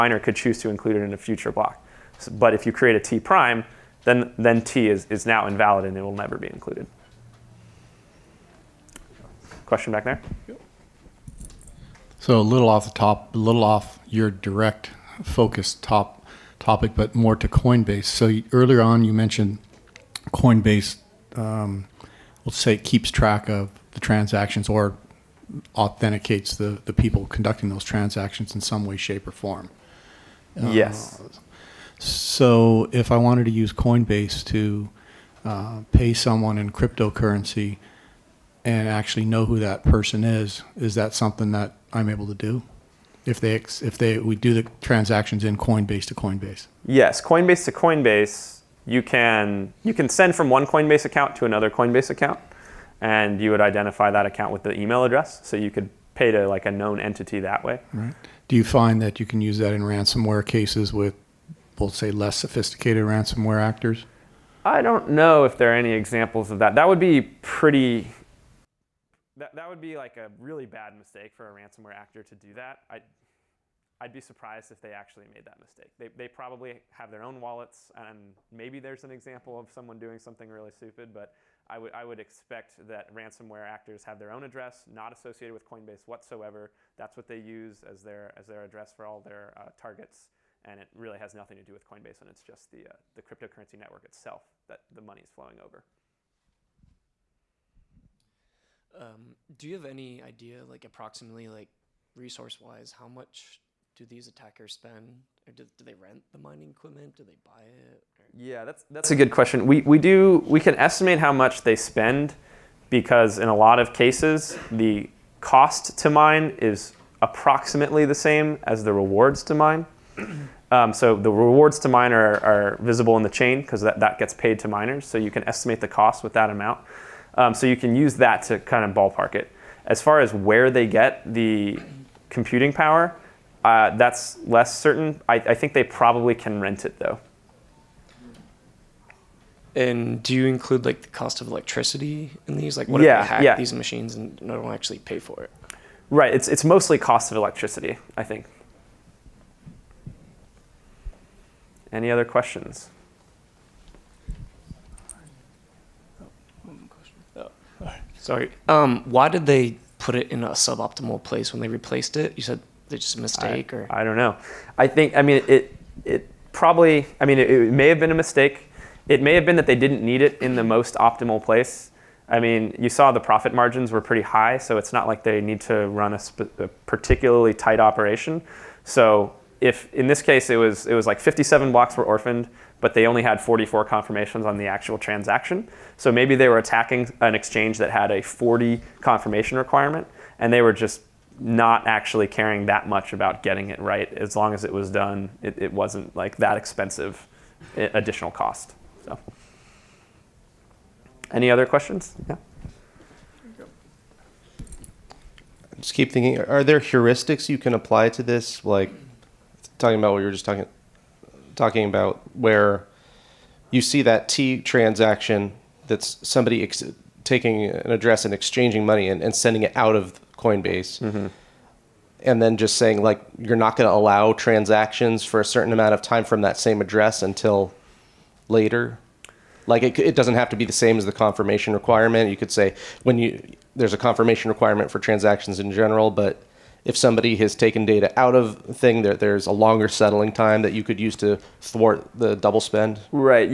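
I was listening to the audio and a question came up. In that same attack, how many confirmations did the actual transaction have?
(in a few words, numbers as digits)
44.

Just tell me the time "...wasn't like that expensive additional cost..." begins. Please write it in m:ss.
3:15.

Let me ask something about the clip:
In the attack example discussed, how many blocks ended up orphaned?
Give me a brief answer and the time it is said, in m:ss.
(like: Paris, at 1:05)
57, at 3:01.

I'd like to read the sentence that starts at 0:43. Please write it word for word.
If they if they we do the transactions in Coinbase to Coinbase.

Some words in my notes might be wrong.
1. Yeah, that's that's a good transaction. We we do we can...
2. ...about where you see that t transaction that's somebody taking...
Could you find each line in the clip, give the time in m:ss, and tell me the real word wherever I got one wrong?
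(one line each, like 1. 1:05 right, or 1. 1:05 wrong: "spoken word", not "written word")
1. 1:48 wrong: "question", not "transaction"
2. 3:31 right.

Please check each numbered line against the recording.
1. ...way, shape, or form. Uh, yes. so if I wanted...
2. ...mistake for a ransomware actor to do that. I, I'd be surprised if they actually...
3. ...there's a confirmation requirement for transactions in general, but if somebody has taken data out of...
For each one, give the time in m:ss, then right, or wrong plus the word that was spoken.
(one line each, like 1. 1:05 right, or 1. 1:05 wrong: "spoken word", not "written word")
1. 0:28 right
2. 1:10 right
3. 3:53 right.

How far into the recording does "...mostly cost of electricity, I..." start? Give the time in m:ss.
2:26.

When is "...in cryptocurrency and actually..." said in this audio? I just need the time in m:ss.
0:36.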